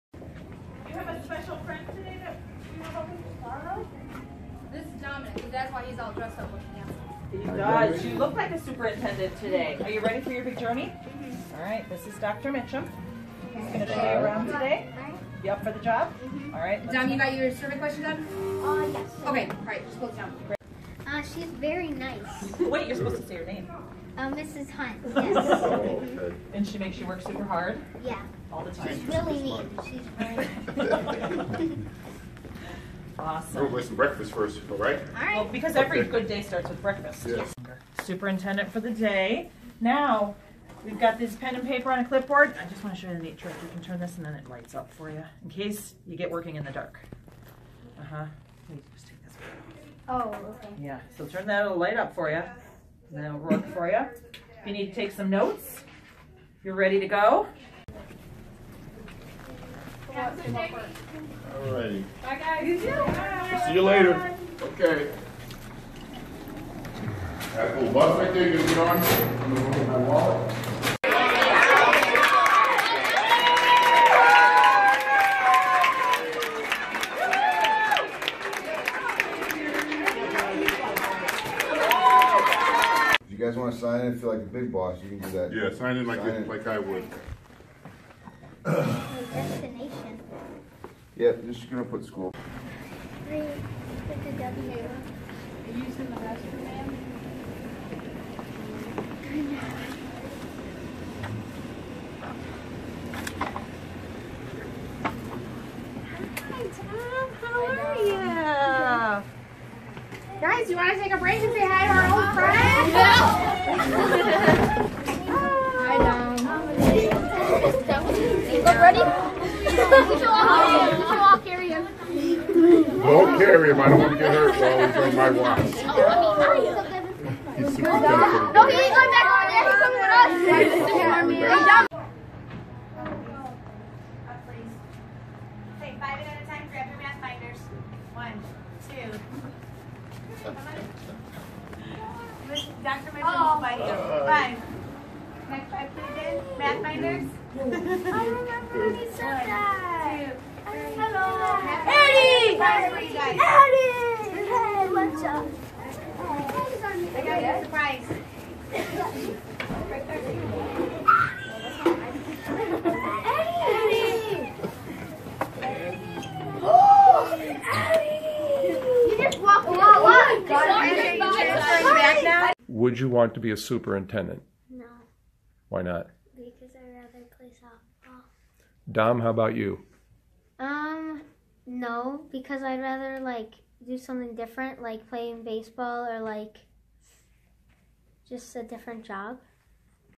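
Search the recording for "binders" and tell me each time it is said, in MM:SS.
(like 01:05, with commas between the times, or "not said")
02:17, 02:26.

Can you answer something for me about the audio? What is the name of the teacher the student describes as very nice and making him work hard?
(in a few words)
Mrs. Hunt.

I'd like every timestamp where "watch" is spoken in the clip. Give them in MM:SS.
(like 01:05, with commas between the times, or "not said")
02:05.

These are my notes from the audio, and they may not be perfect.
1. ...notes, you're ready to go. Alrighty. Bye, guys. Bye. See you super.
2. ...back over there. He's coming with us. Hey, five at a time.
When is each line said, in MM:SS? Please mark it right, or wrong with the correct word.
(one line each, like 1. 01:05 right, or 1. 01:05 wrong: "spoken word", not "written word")
1. 00:55 wrong: "later", not "super"
2. 02:09 right.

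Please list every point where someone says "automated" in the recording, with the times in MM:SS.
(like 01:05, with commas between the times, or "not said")
not said.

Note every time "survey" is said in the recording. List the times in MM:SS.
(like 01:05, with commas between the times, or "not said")
00:17.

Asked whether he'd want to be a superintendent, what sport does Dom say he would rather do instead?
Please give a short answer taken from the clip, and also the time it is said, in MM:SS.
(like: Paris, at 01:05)
Baseball, at 03:05.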